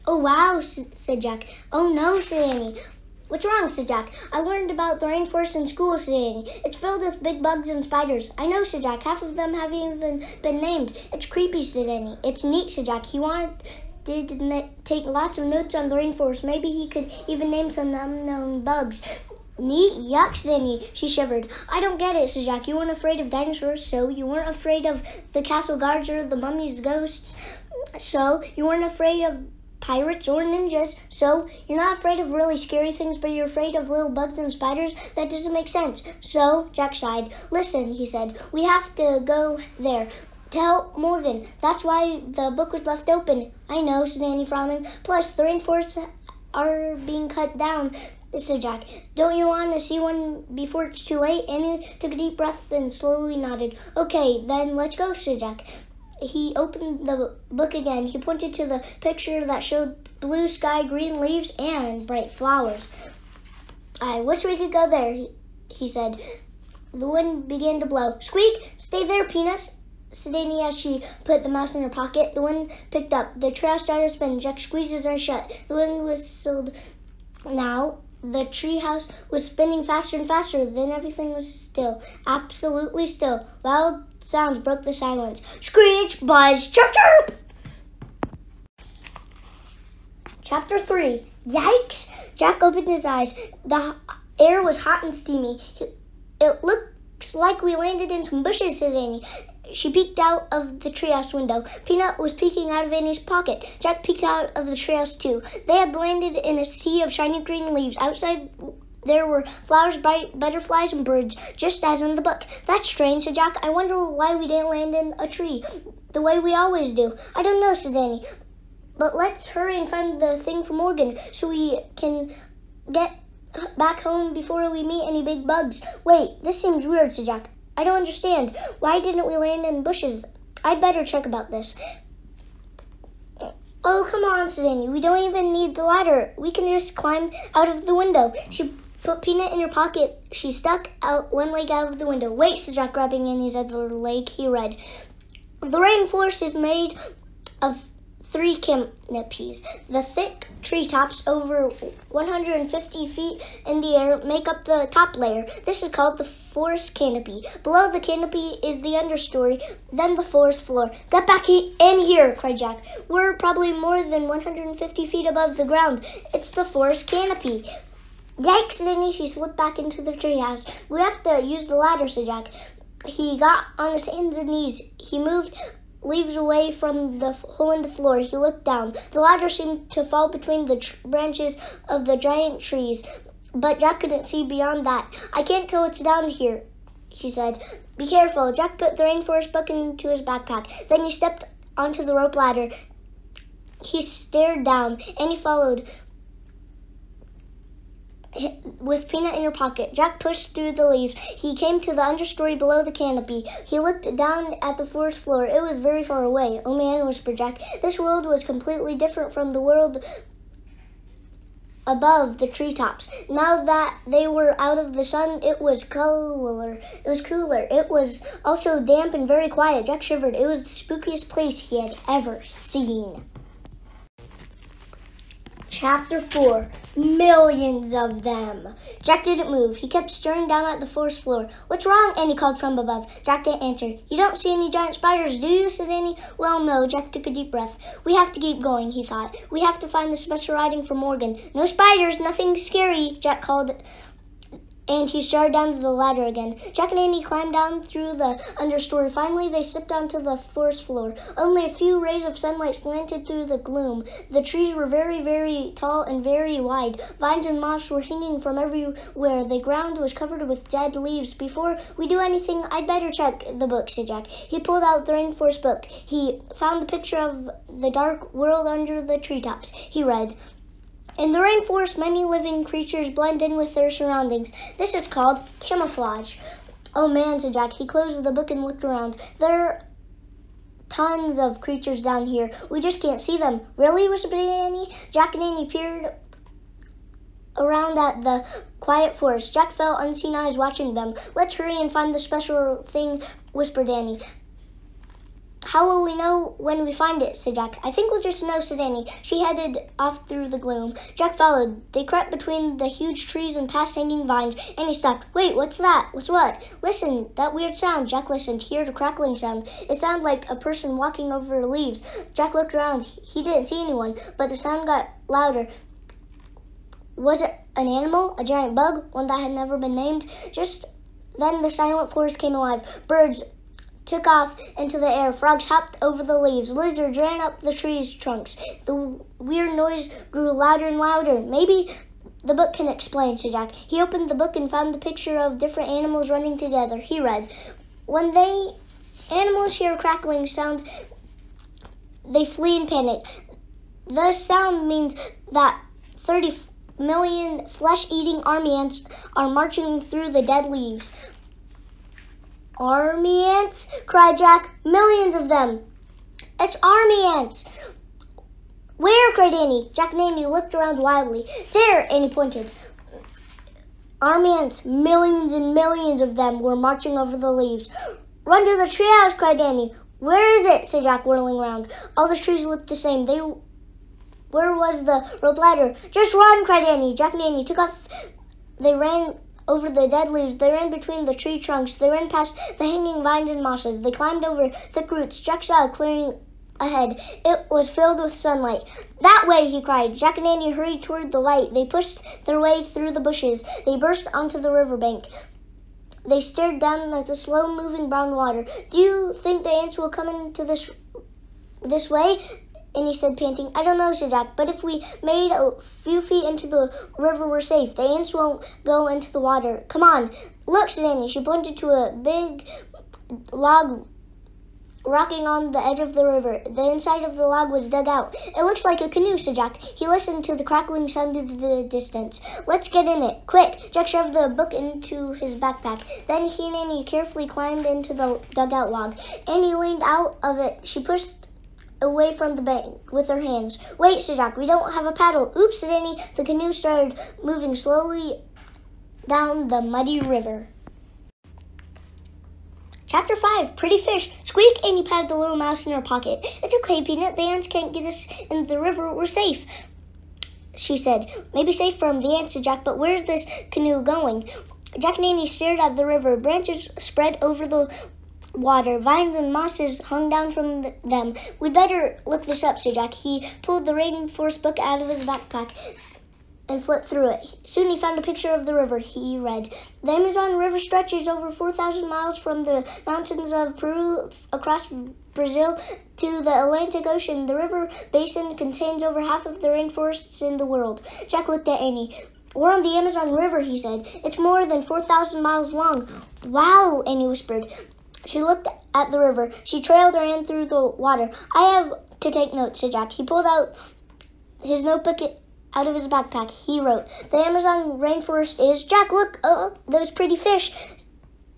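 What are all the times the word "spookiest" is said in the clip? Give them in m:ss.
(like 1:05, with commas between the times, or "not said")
3:40.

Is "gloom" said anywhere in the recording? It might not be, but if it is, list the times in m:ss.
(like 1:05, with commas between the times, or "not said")
4:13, 5:00.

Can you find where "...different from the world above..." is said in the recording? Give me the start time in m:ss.
3:28.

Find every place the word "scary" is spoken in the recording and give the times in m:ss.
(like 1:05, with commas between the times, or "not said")
0:32, 4:02.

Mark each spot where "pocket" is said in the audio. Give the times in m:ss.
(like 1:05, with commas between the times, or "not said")
1:11, 1:43, 2:19, 3:19, 7:26.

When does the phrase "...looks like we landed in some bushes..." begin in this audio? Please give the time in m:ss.
1:36.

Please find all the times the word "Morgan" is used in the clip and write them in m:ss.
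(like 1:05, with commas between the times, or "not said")
0:40, 2:00, 4:00.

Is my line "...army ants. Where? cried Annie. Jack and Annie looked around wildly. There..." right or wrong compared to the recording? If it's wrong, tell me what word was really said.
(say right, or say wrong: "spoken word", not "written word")
right.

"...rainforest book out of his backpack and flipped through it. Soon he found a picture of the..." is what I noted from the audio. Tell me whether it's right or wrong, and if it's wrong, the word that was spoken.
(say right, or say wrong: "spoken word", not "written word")
right.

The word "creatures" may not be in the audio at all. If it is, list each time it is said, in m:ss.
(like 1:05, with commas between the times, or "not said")
4:32, 4:41.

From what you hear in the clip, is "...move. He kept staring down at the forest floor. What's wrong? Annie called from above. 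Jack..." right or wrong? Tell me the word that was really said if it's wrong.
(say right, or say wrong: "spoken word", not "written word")
right.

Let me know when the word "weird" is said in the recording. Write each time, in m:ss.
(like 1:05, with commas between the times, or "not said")
2:06, 5:07, 5:29.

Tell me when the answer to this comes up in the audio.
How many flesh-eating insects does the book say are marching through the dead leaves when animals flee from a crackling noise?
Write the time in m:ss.
5:46.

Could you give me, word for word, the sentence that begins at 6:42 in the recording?
And he said, panting, I don't know, said Jack, but if we made a few feet into the river, we're safe.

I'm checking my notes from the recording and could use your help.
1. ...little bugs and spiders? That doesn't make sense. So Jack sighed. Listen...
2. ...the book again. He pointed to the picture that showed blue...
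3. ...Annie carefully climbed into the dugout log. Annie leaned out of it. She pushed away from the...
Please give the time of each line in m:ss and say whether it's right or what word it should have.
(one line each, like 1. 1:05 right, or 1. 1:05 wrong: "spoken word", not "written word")
1. 0:33 right
2. 0:57 right
3. 7:06 right.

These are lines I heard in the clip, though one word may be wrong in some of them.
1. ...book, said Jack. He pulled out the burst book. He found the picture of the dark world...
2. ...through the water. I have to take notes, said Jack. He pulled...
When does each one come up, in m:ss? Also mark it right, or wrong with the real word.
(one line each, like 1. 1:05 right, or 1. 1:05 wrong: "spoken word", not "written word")
1. 4:23 wrong: "rainforest", not "burst"
2. 8:10 right.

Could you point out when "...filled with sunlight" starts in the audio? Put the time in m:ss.
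6:27.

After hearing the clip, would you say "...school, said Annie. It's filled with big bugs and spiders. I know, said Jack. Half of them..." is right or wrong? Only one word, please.
right.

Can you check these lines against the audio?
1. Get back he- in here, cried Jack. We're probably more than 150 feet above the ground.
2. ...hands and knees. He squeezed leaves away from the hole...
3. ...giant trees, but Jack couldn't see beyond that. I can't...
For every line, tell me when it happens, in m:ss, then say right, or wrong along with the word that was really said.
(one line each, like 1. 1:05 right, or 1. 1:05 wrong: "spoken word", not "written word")
1. 2:41 right
2. 2:54 wrong: "moved", not "squeezed"
3. 3:02 right.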